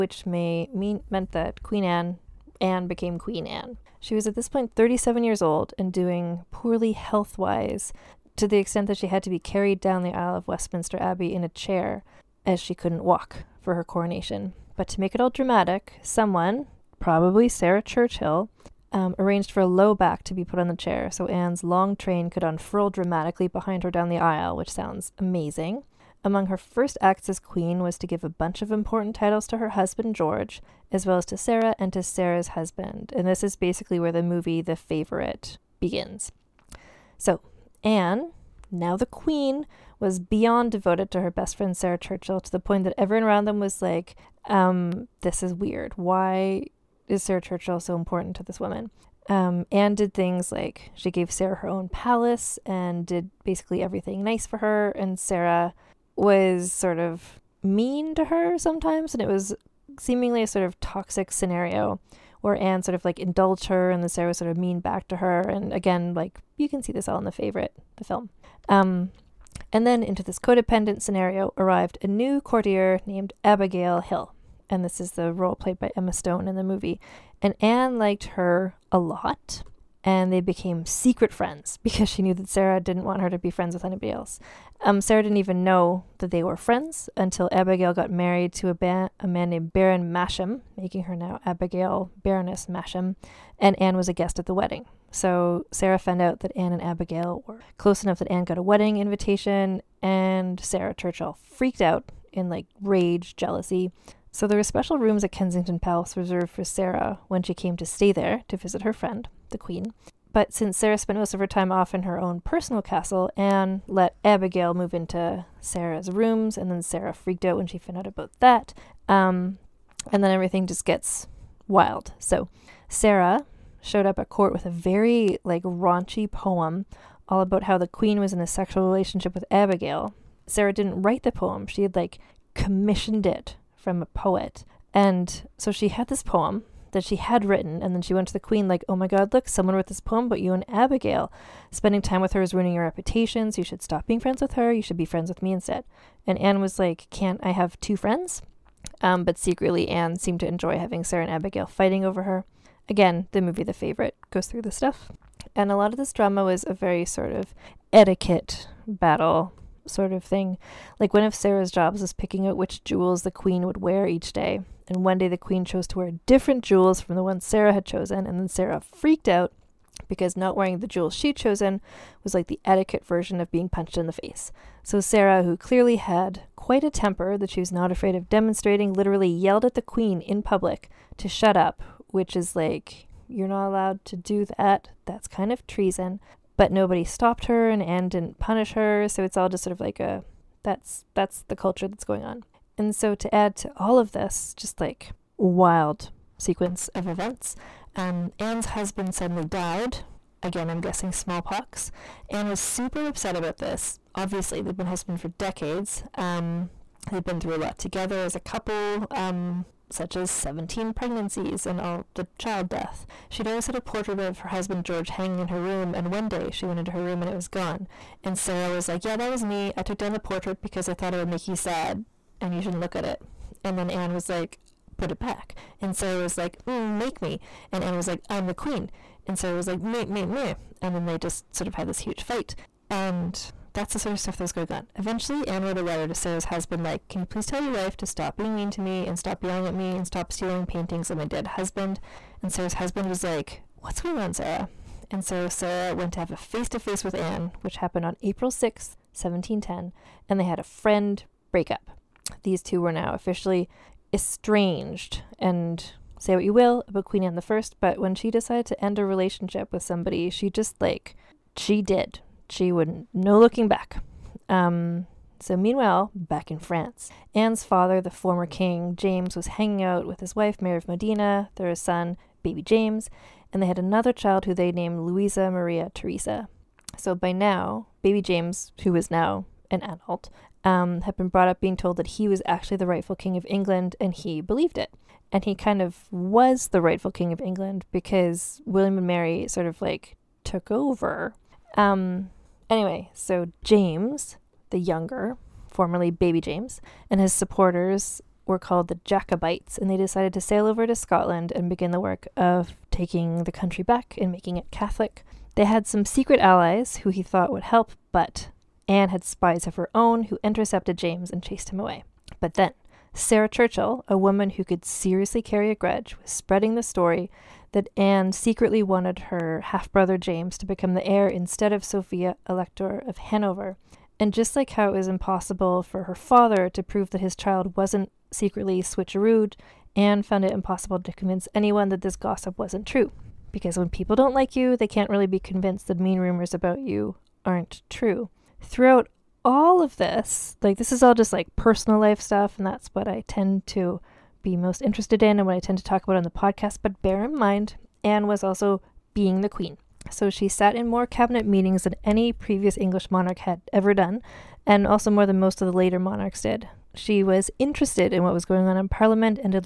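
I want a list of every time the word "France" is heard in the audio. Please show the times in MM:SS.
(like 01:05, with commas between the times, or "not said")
04:26.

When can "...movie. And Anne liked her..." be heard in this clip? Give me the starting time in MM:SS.
01:16.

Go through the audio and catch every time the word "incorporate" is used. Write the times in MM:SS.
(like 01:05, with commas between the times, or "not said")
not said.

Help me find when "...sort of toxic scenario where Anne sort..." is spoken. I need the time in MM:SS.
01:00.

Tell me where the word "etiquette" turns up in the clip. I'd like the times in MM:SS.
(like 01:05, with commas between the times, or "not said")
02:37, 02:52.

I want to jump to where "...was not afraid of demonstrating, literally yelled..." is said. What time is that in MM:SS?
02:57.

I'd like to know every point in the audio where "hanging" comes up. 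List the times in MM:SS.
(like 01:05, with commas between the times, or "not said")
03:35, 04:29.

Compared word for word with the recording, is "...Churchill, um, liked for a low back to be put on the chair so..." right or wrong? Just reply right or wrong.
wrong.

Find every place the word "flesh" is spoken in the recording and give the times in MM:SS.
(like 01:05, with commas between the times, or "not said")
not said.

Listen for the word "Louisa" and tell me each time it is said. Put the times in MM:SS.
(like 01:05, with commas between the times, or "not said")
04:34.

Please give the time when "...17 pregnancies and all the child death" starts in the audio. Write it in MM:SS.
03:30.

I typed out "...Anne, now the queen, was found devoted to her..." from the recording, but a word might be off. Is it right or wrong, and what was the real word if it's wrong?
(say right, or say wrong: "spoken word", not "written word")
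wrong: "beyond", not "found".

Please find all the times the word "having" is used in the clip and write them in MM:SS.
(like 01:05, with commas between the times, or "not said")
02:30.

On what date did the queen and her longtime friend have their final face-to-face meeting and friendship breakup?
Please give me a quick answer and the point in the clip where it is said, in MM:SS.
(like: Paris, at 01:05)
April 6th, 1710, at 04:08.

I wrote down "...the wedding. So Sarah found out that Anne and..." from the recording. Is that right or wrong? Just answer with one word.
right.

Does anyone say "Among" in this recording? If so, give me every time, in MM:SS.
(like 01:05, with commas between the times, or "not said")
00:26.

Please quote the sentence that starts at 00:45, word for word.
Why is Sarah Churchill so important to this woman?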